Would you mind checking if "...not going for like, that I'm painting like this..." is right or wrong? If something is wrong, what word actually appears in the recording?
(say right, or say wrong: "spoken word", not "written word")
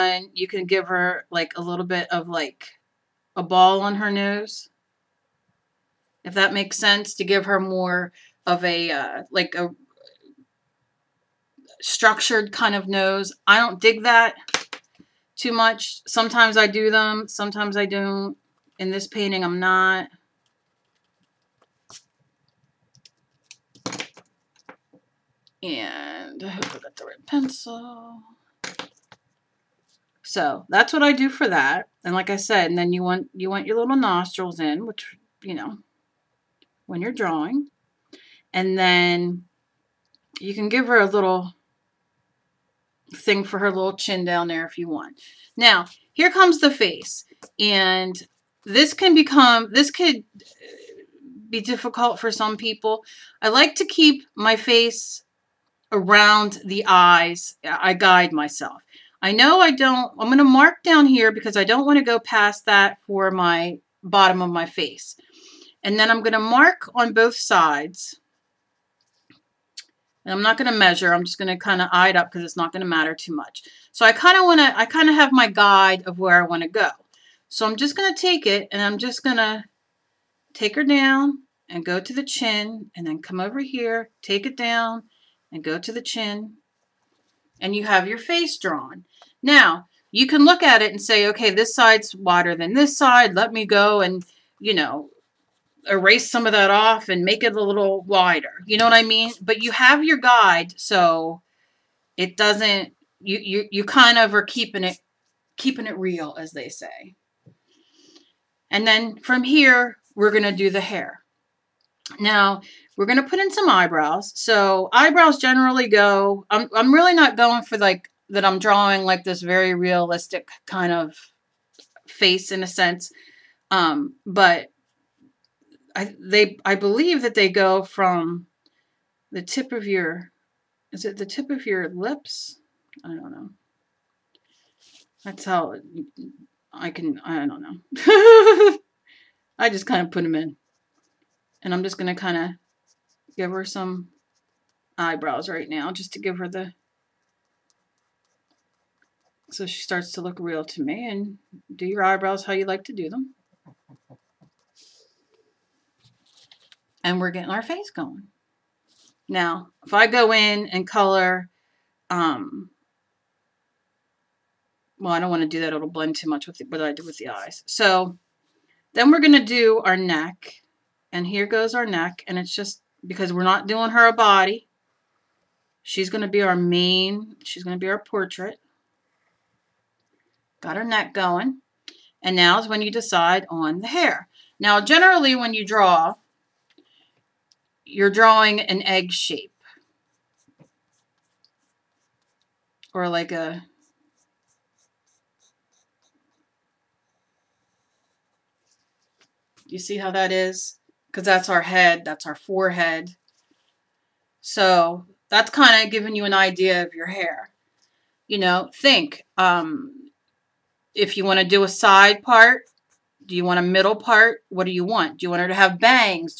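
wrong: "drawing", not "painting".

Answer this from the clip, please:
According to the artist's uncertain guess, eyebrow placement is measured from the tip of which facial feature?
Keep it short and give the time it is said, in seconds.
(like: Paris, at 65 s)
lips, at 131 s.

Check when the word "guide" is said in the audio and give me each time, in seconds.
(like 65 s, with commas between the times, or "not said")
57 s, 75 s, 100 s.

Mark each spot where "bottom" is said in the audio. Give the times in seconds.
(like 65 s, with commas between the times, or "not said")
64 s.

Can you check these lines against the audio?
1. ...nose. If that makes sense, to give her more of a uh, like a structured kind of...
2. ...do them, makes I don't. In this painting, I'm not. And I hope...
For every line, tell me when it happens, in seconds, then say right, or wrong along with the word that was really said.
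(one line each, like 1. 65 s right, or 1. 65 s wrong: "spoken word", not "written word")
1. 4 s right
2. 16 s wrong: "sometimes", not "makes".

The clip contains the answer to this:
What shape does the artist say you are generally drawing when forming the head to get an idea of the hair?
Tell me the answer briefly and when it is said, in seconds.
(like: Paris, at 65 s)
egg shape, at 188 s.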